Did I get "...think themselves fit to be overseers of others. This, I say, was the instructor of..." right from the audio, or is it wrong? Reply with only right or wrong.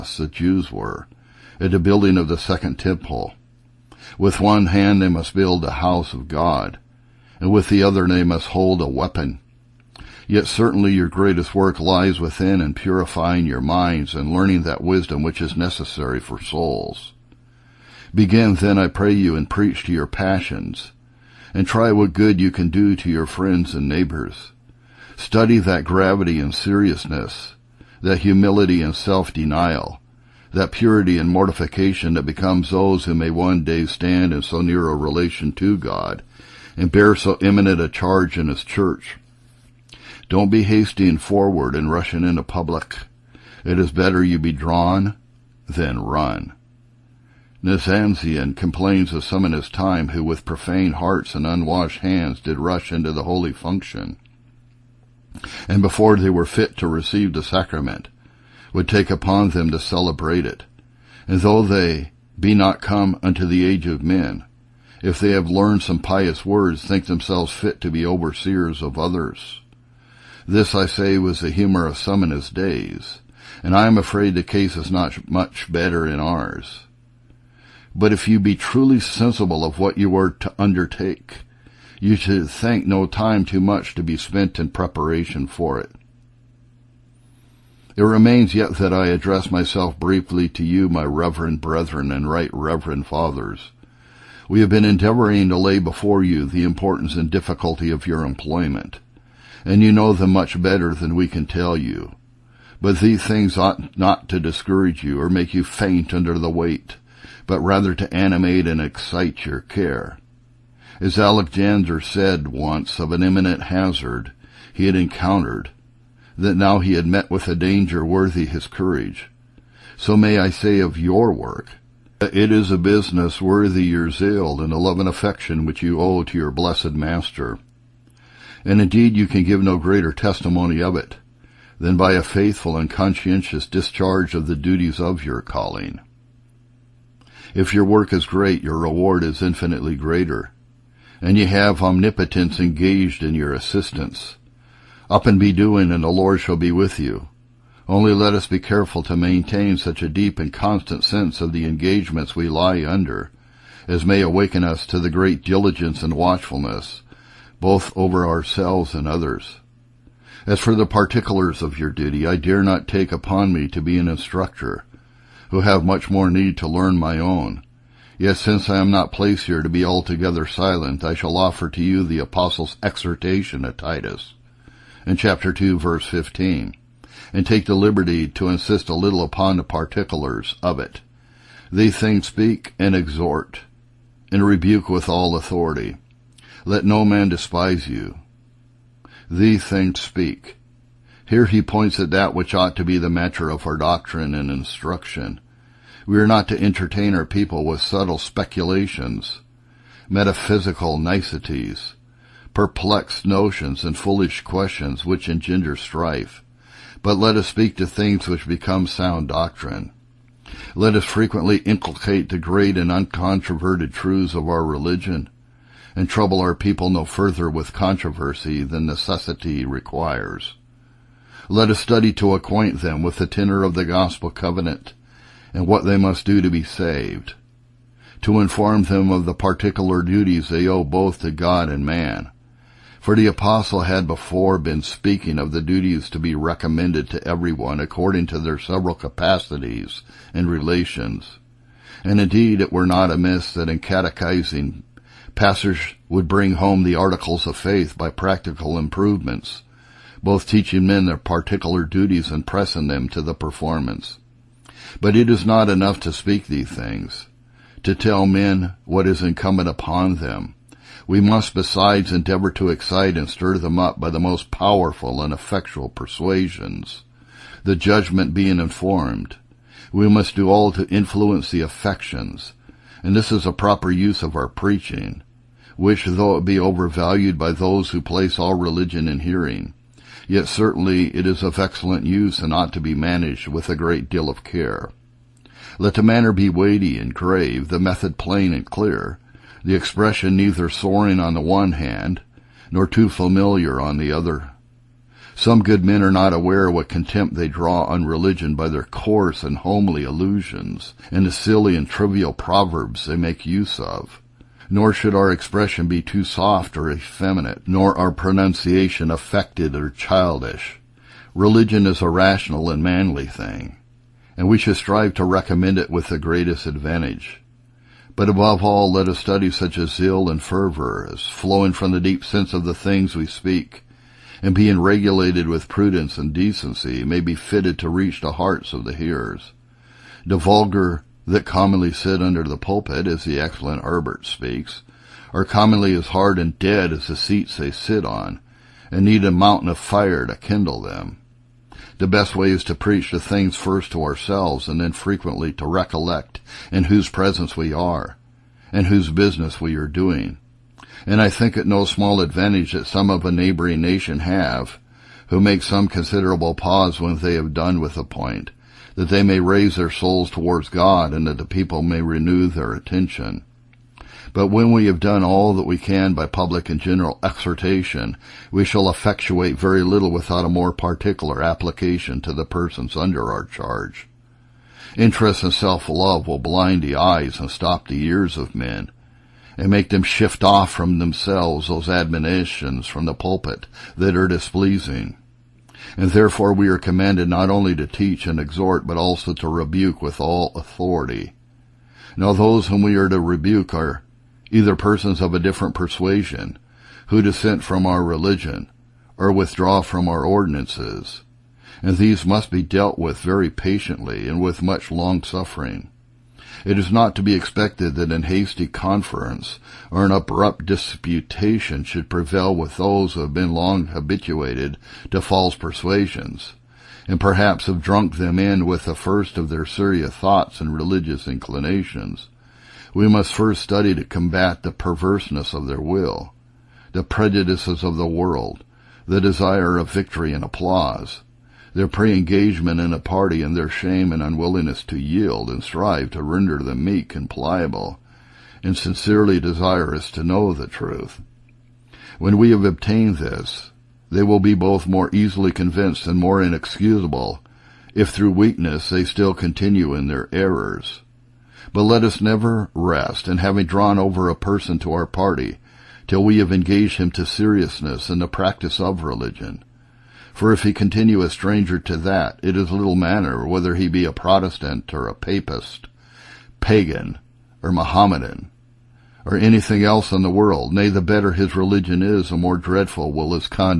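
wrong.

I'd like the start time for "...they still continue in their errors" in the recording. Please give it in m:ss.
7:28.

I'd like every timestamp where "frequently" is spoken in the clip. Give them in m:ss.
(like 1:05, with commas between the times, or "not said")
3:31, 5:44.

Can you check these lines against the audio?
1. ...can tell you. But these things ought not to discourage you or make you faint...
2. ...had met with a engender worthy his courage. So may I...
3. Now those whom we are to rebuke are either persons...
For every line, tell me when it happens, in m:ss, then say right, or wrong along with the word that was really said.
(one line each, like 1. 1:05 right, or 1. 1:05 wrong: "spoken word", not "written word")
1. 1:41 right
2. 1:56 wrong: "danger", not "engender"
3. 6:32 right.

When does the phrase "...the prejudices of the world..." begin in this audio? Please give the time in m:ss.
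7:06.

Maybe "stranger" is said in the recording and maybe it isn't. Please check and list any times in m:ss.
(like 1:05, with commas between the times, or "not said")
7:41.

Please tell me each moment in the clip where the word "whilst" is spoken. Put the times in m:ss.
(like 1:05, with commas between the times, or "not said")
not said.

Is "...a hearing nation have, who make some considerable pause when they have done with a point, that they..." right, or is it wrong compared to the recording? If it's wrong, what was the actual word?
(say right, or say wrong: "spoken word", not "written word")
wrong: "neighboring", not "hearing".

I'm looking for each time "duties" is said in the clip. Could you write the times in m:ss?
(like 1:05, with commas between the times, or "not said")
2:14, 3:50, 3:55, 4:11.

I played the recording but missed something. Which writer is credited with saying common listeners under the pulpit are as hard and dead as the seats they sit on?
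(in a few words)
Herbert.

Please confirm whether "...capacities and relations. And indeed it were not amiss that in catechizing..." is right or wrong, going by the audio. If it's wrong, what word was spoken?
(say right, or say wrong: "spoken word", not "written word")
right.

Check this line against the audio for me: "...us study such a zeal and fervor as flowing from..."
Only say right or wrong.
right.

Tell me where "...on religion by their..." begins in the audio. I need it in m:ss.
4:57.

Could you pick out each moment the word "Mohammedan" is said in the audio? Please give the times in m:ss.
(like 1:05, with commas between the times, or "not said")
7:47.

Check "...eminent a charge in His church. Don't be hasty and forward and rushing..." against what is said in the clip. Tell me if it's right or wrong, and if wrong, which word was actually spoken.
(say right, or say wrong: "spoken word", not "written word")
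right.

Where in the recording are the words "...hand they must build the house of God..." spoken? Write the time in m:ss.
0:04.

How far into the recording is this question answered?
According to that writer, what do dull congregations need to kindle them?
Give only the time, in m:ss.
5:39.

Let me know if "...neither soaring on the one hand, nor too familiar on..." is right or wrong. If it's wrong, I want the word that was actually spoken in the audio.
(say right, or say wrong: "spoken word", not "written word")
right.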